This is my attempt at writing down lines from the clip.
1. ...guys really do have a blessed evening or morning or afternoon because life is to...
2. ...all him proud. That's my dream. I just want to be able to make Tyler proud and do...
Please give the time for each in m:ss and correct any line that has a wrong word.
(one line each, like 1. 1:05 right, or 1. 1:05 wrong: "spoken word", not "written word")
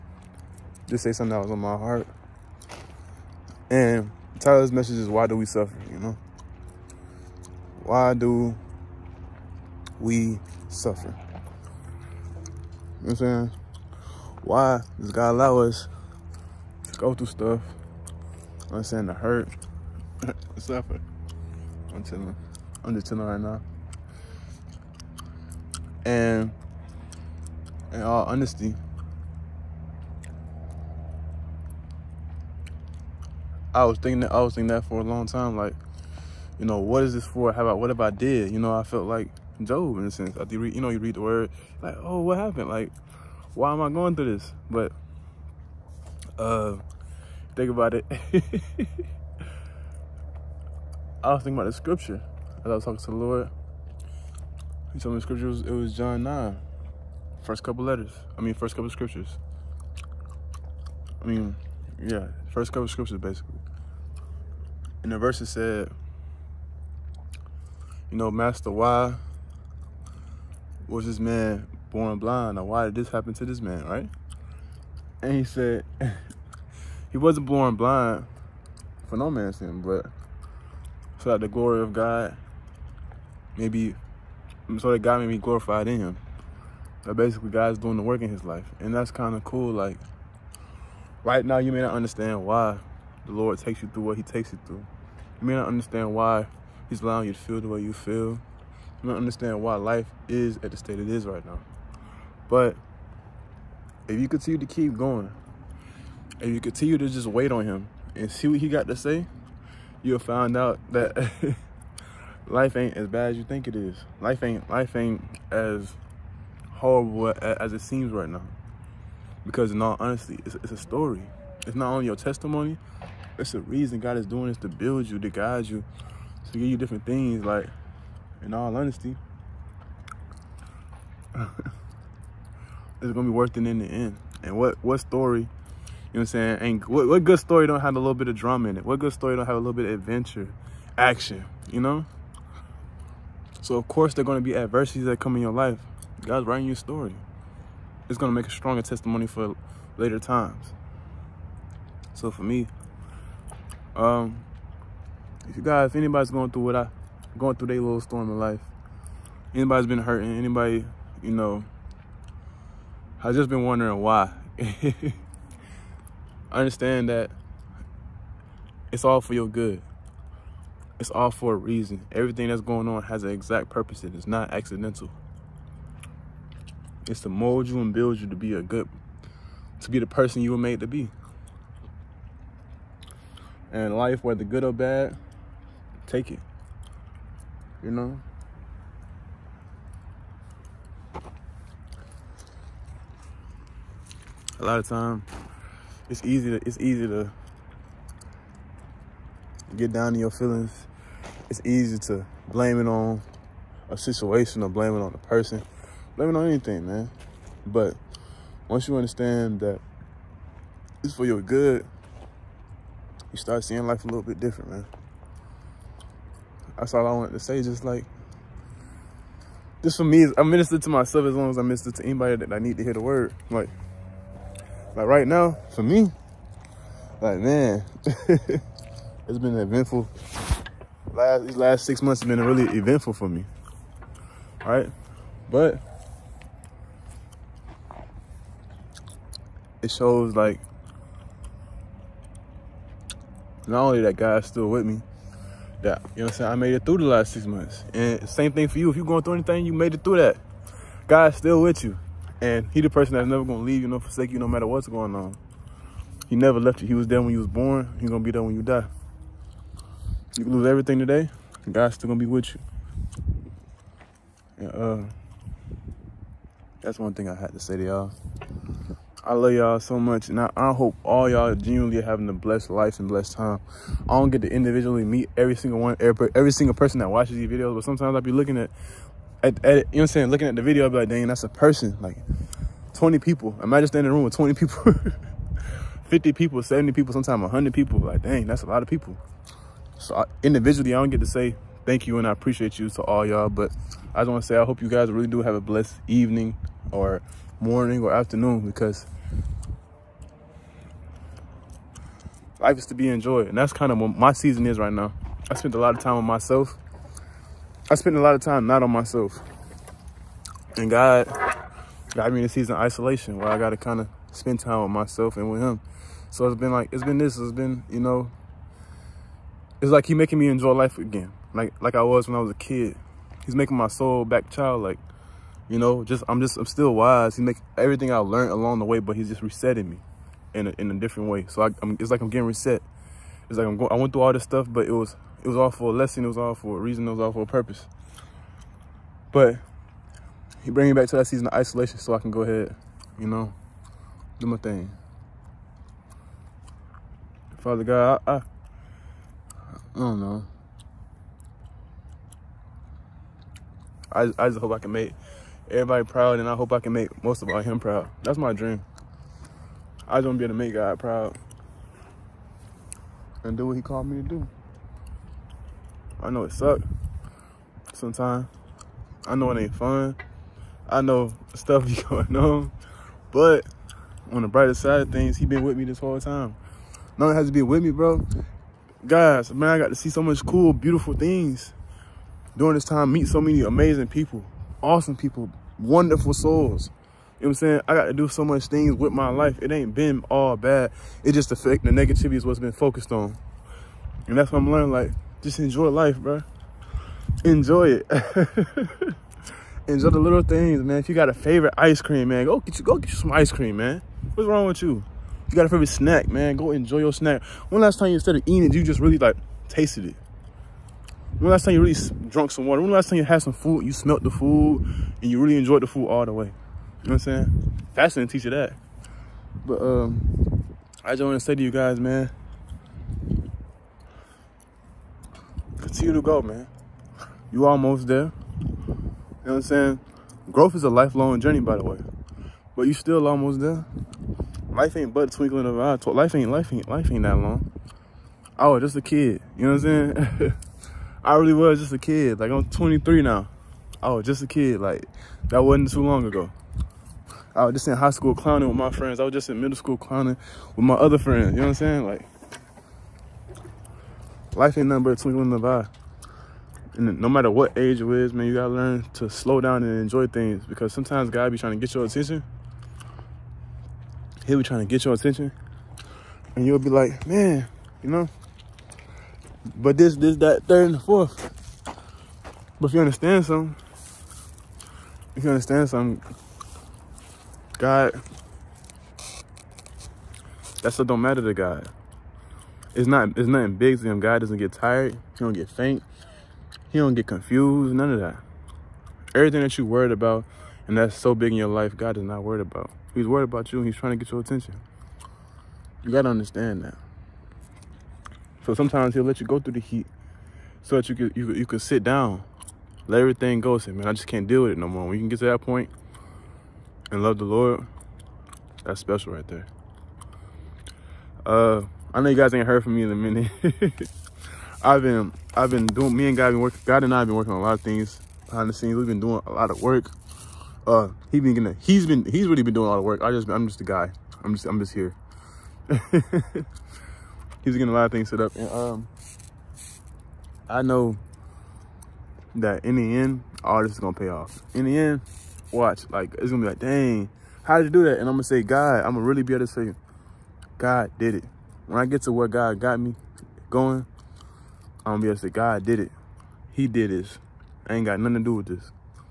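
1. 4:54 right
2. 5:57 wrong: "God", not "Tyler".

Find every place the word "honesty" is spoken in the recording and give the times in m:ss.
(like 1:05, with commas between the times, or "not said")
0:28, 1:59, 2:08.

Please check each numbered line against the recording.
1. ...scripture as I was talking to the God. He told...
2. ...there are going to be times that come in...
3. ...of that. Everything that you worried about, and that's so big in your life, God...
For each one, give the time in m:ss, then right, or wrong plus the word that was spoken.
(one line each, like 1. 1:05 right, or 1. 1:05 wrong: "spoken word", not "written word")
1. 0:51 wrong: "Lord", not "God"
2. 2:24 wrong: "adversities", not "times"
3. 8:08 right.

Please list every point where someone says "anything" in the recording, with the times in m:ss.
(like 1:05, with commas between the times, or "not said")
3:26, 4:09.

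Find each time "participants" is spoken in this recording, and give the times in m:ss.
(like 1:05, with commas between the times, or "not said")
not said.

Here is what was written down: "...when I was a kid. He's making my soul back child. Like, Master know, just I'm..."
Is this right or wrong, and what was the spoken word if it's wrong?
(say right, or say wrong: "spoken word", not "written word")
wrong: "You", not "Master".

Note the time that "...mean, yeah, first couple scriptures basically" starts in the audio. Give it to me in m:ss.
1:01.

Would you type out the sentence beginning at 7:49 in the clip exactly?
But this, this, that, third, and the fourth.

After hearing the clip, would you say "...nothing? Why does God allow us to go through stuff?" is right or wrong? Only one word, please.
wrong.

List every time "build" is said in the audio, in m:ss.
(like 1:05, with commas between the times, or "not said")
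2:04, 2:57.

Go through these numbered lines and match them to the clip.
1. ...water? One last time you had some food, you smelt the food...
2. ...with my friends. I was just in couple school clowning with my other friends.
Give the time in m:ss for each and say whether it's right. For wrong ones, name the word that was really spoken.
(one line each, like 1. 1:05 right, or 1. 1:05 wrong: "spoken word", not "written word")
1. 6:52 right
2. 7:28 wrong: "middle", not "couple".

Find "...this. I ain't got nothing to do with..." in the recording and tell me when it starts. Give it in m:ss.
9:07.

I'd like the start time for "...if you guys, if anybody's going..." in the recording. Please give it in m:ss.
2:35.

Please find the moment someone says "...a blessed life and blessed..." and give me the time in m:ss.
4:32.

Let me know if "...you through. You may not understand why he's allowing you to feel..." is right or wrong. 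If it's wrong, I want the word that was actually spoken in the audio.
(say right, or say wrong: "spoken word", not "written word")
right.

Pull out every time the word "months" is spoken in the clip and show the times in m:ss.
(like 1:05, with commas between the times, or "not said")
3:52, 4:07.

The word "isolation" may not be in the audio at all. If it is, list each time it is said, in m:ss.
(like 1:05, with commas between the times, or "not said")
5:12, 5:41.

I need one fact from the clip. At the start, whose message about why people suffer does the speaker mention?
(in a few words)
Tyler.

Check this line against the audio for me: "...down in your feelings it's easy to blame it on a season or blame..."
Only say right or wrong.
wrong.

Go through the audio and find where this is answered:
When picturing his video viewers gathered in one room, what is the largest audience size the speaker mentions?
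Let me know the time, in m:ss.
4:47.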